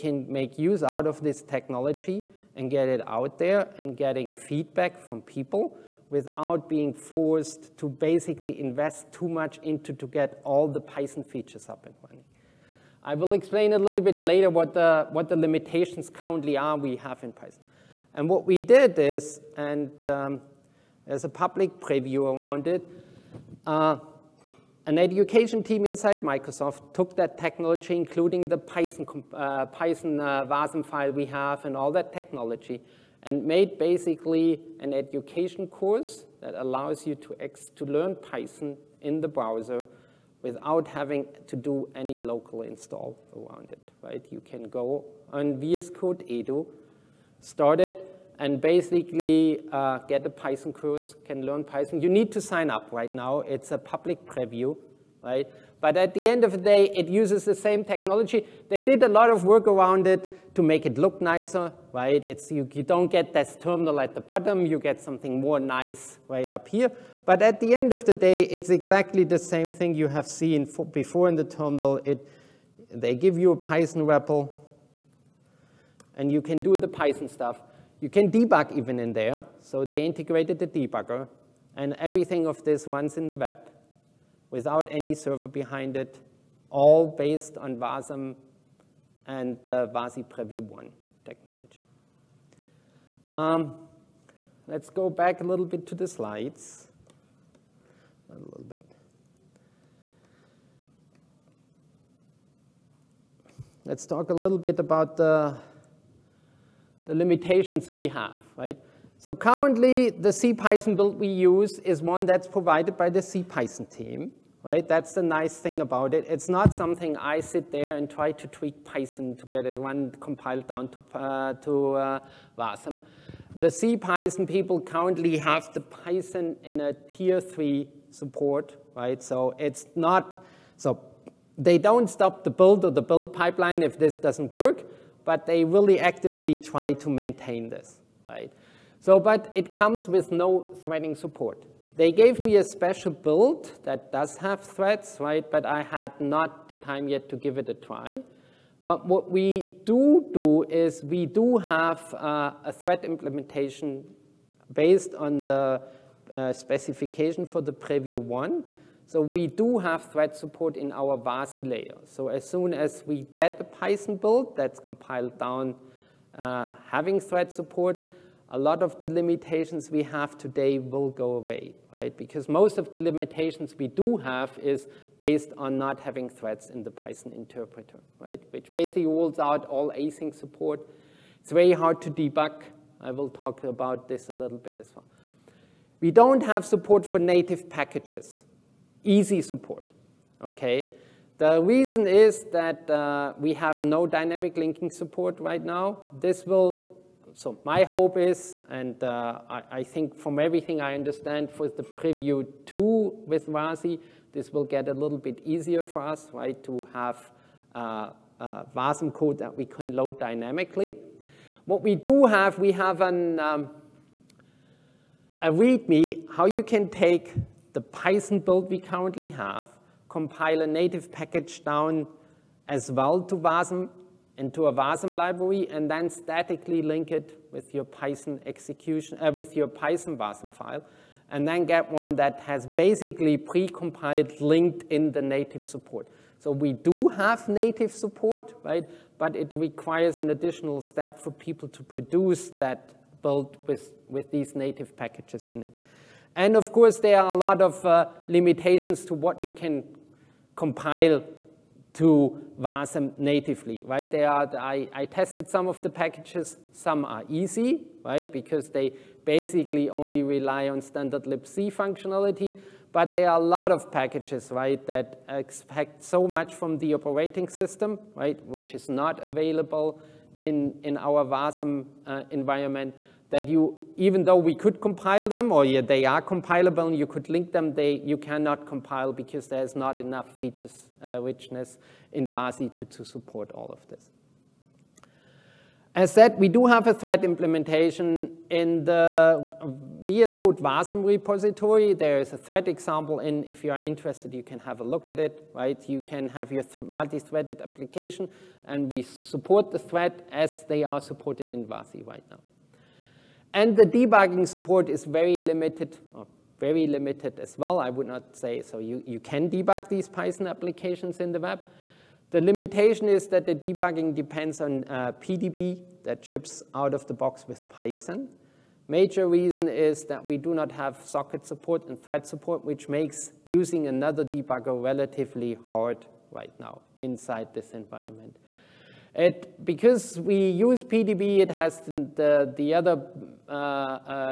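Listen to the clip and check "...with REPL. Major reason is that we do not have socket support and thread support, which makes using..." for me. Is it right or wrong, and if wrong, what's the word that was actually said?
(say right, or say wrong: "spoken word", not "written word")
wrong: "Python", not "REPL".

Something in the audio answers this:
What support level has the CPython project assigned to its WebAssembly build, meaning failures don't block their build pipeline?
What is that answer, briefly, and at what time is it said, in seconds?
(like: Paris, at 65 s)
tier three, at 126 s.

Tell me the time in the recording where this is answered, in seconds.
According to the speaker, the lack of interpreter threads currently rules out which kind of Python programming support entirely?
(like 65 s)
179 s.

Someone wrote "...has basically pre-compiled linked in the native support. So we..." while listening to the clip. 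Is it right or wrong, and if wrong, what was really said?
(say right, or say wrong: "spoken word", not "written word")
right.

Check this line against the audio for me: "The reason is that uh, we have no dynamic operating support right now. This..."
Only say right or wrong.
wrong.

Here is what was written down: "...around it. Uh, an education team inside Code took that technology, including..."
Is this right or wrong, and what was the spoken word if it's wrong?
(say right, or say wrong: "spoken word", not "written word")
wrong: "Microsoft", not "Code".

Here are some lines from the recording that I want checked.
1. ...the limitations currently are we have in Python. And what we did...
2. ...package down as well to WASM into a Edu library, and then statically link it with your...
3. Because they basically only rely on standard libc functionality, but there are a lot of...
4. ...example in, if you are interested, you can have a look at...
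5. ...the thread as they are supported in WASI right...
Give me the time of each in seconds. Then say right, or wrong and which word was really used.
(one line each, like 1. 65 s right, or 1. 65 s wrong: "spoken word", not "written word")
1. 15 s right
2. 221 s wrong: "WASM", not "Edu"
3. 258 s right
4. 292 s right
5. 299 s right.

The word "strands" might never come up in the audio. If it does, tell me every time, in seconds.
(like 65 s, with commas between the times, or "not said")
not said.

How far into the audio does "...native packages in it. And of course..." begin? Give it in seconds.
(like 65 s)
244 s.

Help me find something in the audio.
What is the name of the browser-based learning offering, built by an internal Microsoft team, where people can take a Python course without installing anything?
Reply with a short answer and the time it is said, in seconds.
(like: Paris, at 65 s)
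VS Code Edu, at 45 s.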